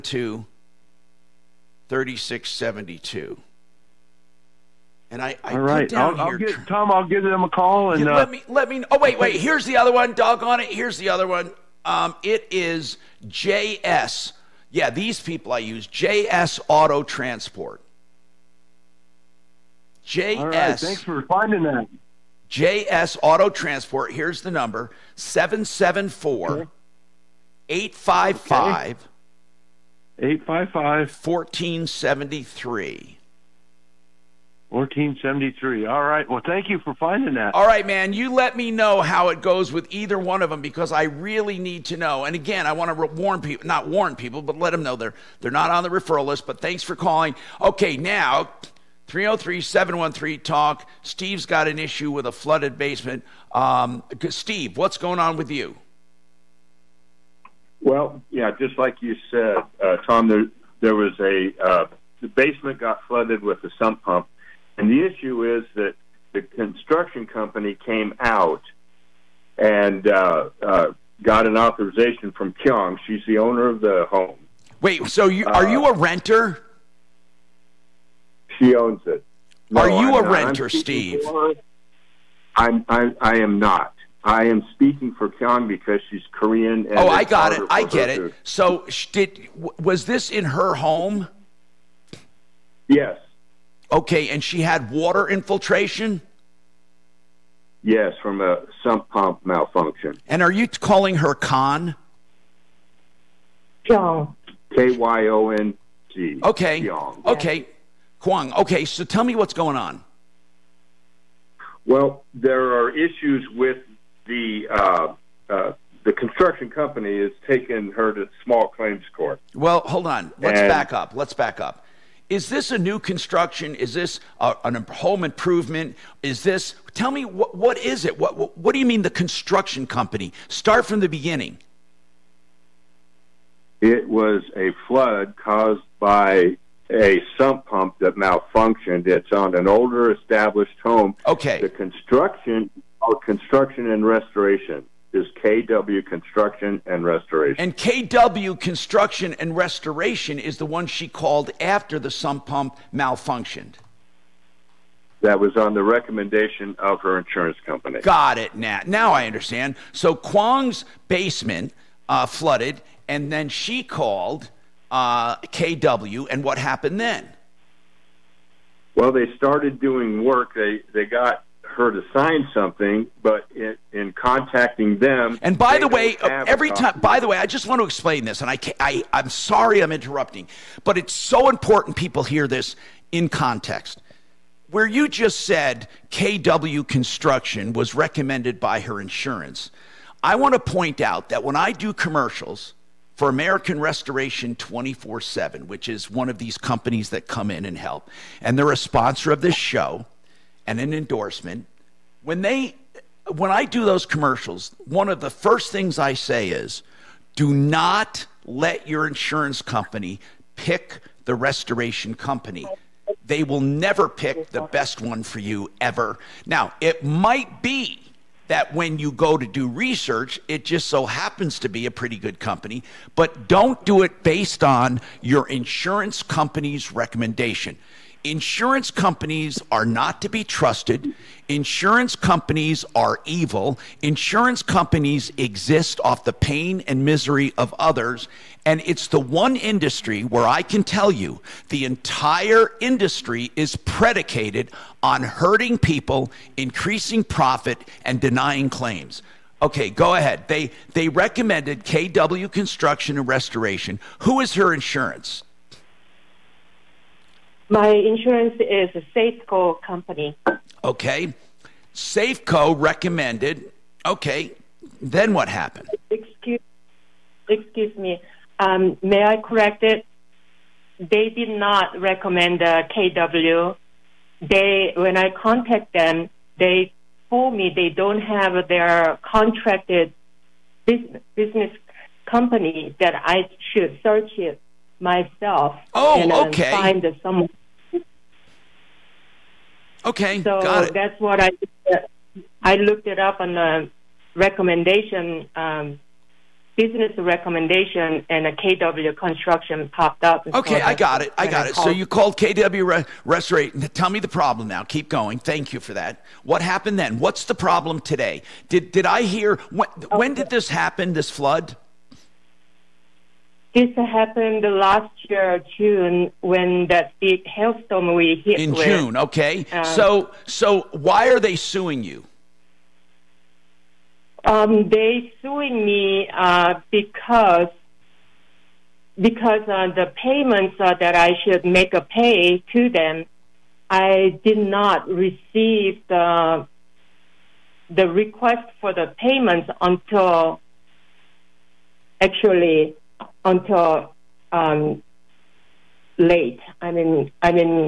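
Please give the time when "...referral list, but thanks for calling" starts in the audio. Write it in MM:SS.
00:45.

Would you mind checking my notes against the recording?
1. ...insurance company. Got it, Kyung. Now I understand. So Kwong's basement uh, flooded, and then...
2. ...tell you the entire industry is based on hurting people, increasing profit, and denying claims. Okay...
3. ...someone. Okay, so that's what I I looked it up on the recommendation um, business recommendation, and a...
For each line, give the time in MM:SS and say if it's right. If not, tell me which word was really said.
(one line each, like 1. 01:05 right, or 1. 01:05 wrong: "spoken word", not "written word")
1. 02:37 wrong: "Nat", not "Kyung"
2. 04:00 wrong: "predicated", not "based"
3. 04:47 right.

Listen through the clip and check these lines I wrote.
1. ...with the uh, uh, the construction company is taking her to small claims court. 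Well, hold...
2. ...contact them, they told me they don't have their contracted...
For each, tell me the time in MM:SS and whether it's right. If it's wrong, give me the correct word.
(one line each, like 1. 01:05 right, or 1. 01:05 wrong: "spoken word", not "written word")
1. 01:53 right
2. 04:35 right.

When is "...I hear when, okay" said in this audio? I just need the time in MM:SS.
05:09.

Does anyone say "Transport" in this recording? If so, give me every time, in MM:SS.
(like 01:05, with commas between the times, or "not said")
00:17, 00:23.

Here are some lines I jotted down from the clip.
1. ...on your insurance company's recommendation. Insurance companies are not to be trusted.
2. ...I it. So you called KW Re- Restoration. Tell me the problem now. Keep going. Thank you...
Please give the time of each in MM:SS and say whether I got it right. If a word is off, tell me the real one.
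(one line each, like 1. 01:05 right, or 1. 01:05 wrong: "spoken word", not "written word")
1. 03:44 right
2. 05:01 right.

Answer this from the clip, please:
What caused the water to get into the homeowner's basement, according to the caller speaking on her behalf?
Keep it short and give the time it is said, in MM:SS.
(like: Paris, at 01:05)
sump pump malfunction, at 01:38.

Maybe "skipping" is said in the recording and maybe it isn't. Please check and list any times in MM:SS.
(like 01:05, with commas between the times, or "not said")
not said.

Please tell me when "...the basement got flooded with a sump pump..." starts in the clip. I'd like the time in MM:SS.
01:02.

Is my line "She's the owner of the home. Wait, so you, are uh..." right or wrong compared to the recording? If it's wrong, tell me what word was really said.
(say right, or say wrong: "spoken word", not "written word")
right.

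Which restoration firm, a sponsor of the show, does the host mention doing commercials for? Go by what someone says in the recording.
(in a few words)
American Restoration 24 7.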